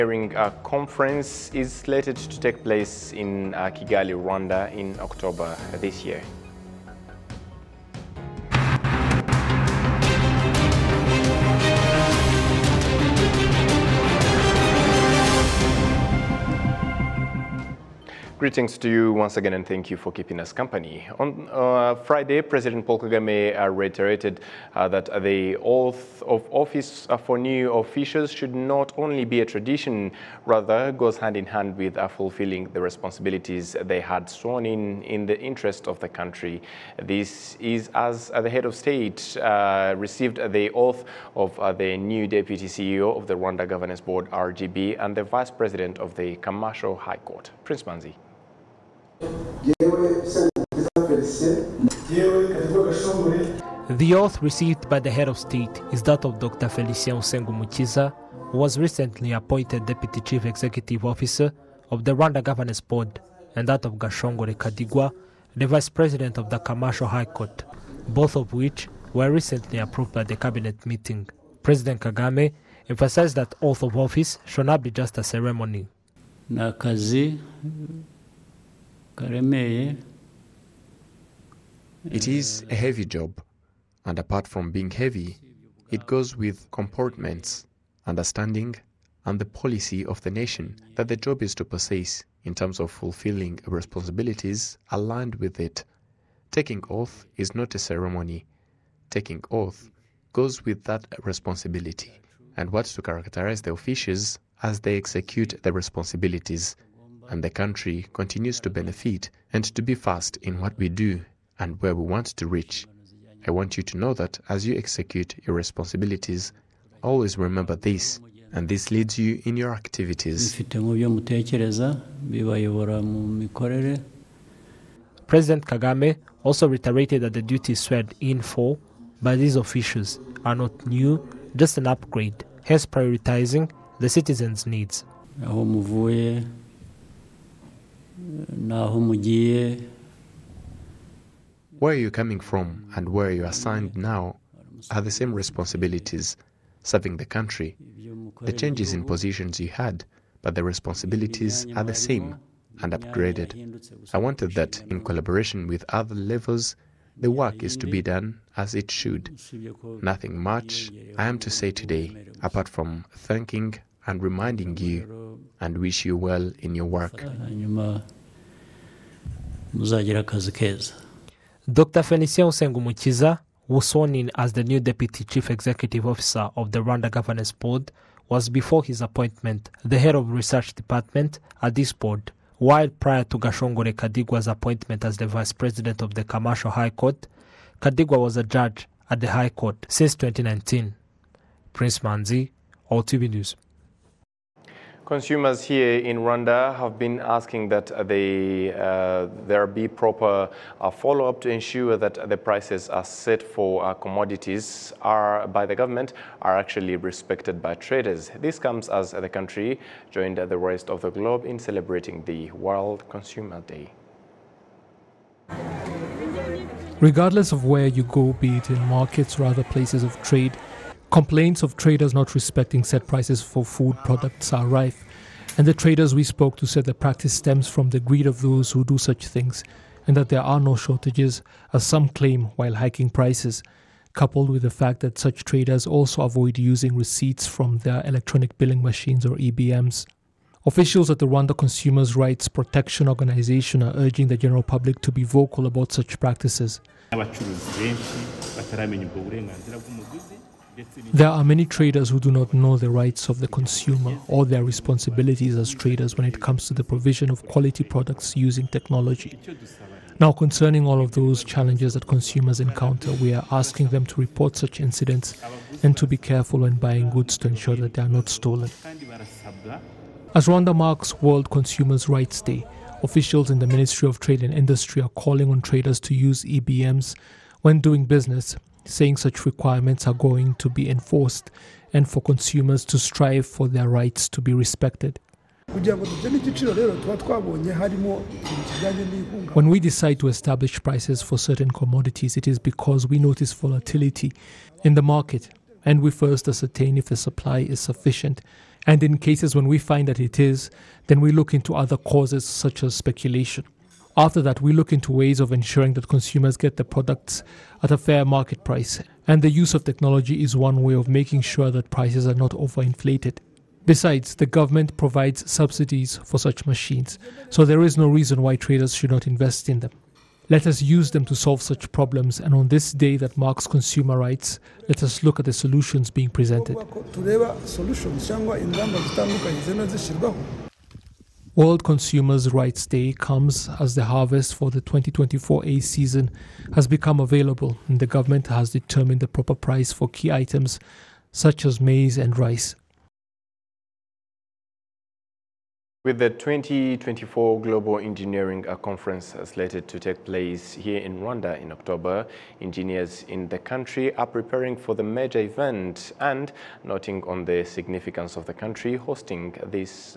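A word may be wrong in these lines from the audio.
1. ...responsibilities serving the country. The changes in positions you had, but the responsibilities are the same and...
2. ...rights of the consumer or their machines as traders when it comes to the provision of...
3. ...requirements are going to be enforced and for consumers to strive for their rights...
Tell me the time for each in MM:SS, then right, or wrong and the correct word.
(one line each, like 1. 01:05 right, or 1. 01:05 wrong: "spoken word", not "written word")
1. 02:25 right
2. 04:12 wrong: "responsibilities", not "machines"
3. 04:39 right.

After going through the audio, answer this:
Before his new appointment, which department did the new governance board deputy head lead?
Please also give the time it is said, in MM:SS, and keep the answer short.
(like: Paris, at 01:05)
Research department, at 02:59.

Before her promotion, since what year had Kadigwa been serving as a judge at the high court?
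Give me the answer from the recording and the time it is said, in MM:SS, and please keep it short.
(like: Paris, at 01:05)
2019, at 03:09.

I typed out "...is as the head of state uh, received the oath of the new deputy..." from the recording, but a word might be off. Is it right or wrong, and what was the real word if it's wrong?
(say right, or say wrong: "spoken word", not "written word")
right.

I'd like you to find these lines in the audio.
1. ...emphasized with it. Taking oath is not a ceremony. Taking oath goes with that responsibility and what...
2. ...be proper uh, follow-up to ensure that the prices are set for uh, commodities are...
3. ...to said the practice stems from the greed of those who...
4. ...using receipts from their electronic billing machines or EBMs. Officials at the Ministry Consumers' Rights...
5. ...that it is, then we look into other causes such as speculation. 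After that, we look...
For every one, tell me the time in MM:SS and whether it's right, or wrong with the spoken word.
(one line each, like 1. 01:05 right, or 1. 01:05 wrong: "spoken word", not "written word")
1. 01:34 wrong: "aligned", not "emphasized"
2. 03:19 right
3. 03:46 right
4. 03:56 wrong: "Rwanda", not "Ministry"
5. 05:00 right.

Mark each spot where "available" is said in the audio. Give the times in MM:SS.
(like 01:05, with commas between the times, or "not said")
05:37.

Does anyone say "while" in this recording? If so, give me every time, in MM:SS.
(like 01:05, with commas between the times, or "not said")
03:02, 03:52.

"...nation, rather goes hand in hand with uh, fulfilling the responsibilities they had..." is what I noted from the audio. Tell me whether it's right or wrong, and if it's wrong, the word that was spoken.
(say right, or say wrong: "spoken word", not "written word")
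wrong: "tradition", not "nation".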